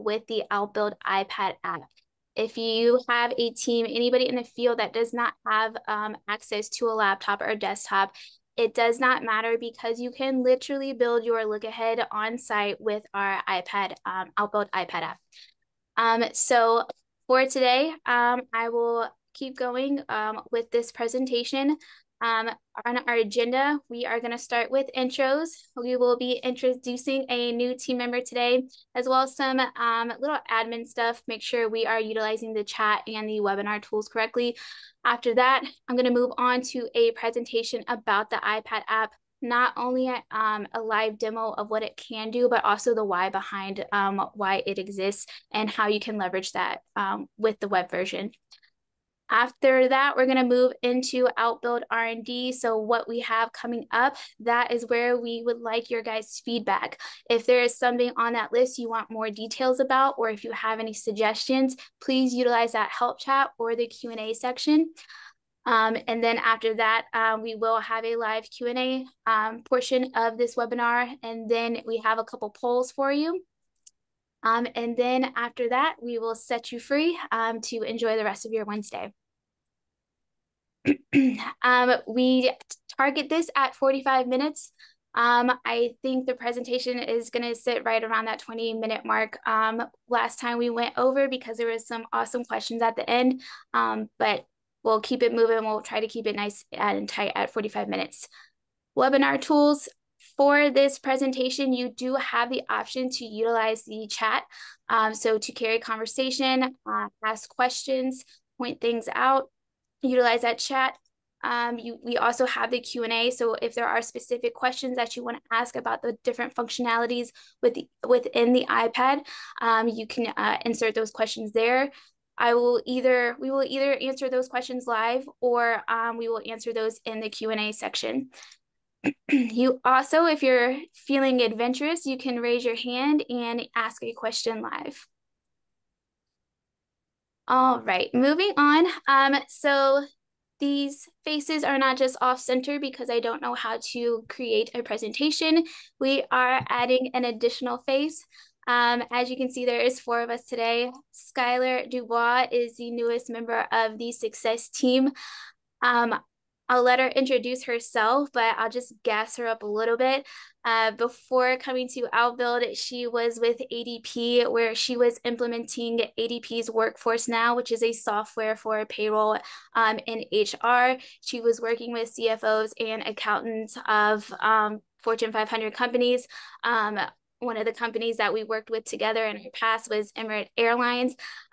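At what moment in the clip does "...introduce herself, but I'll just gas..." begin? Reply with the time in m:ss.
2:37.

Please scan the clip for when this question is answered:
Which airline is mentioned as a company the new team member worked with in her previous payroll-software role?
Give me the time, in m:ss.
3:00.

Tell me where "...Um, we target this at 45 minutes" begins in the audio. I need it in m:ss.
1:21.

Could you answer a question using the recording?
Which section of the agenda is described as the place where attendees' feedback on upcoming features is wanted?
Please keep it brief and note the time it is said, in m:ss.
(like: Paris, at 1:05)
Outbuild R&D, at 0:51.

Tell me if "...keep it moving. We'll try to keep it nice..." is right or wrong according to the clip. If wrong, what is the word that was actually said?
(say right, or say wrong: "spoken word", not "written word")
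right.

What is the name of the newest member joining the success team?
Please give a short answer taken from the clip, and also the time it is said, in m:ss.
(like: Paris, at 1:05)
Skylar Dubois, at 2:31.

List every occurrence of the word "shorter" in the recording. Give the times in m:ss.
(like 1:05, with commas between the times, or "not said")
not said.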